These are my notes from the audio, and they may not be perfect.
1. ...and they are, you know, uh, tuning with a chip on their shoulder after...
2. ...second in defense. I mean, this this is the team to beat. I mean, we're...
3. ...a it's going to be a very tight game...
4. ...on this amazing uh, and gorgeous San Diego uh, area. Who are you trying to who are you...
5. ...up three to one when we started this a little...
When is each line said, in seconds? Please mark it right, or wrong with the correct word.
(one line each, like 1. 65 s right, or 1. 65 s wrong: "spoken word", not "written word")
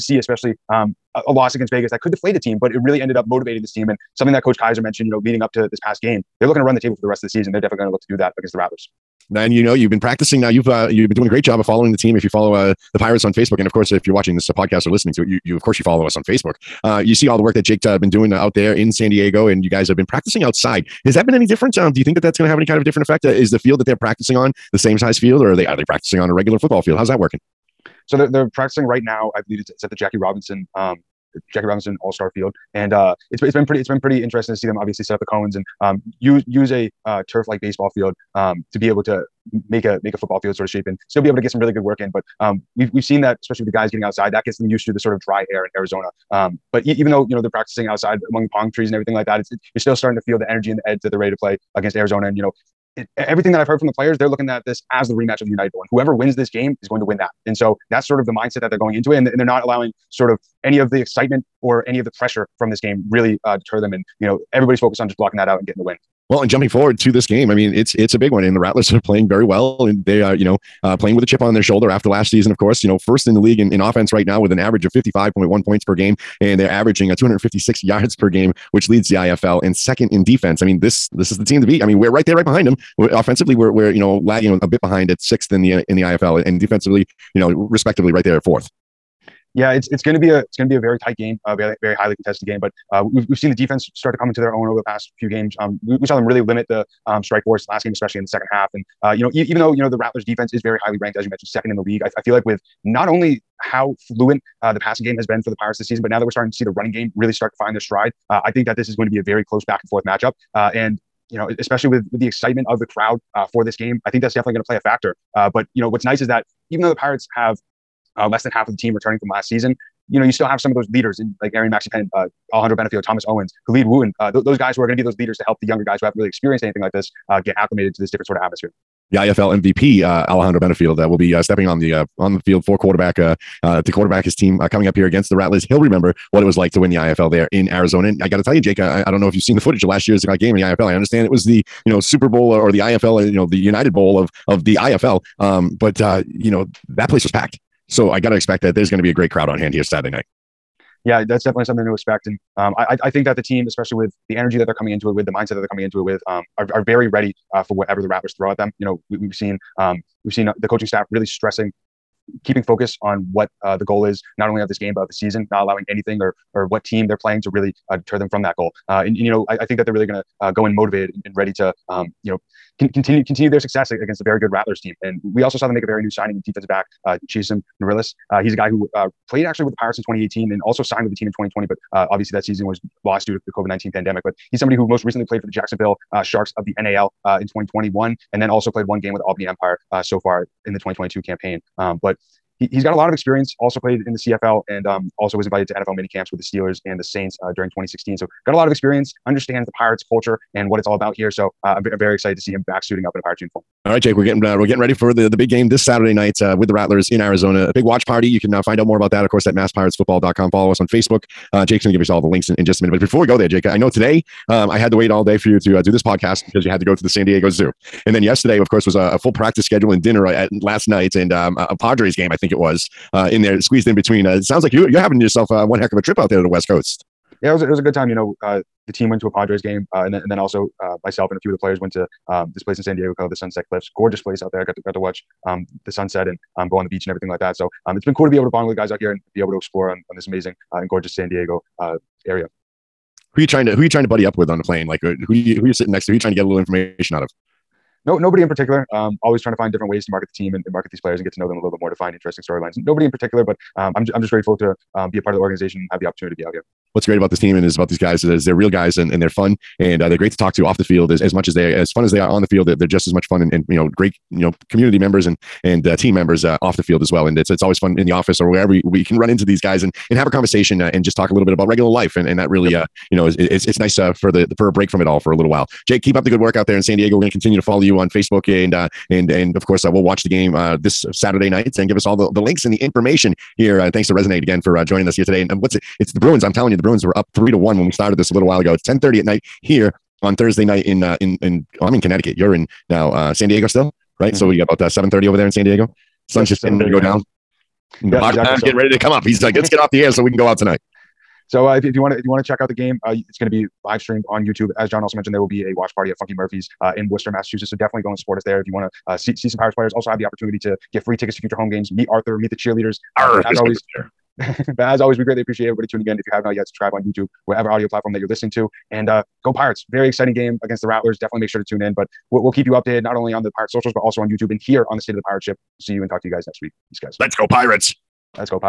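1. 69 s wrong: "playing", not "tuning"
2. 79 s right
3. 90 s right
4. 240 s right
5. 287 s right.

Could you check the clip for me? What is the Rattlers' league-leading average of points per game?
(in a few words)
55.1.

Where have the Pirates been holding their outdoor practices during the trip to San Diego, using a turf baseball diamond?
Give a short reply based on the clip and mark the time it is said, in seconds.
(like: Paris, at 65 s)
Jackie Robinson All Star Field, at 31 s.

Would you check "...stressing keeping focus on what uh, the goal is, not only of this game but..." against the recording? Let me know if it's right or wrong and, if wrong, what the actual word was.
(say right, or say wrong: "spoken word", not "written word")
right.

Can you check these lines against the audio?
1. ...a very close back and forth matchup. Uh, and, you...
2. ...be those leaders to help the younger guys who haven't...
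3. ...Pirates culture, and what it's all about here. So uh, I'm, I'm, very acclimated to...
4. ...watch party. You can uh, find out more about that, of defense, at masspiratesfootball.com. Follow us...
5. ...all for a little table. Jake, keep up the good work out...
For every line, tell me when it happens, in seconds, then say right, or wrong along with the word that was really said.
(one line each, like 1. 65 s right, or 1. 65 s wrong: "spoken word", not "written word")
1. 109 s right
2. 124 s right
3. 199 s wrong: "excited", not "acclimated"
4. 207 s wrong: "course", not "defense"
5. 275 s wrong: "while", not "table".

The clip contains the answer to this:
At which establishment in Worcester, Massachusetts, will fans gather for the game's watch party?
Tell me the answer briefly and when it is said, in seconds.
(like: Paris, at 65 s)
Funky Murphy's, at 306 s.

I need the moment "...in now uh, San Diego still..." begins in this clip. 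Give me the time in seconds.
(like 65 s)
292 s.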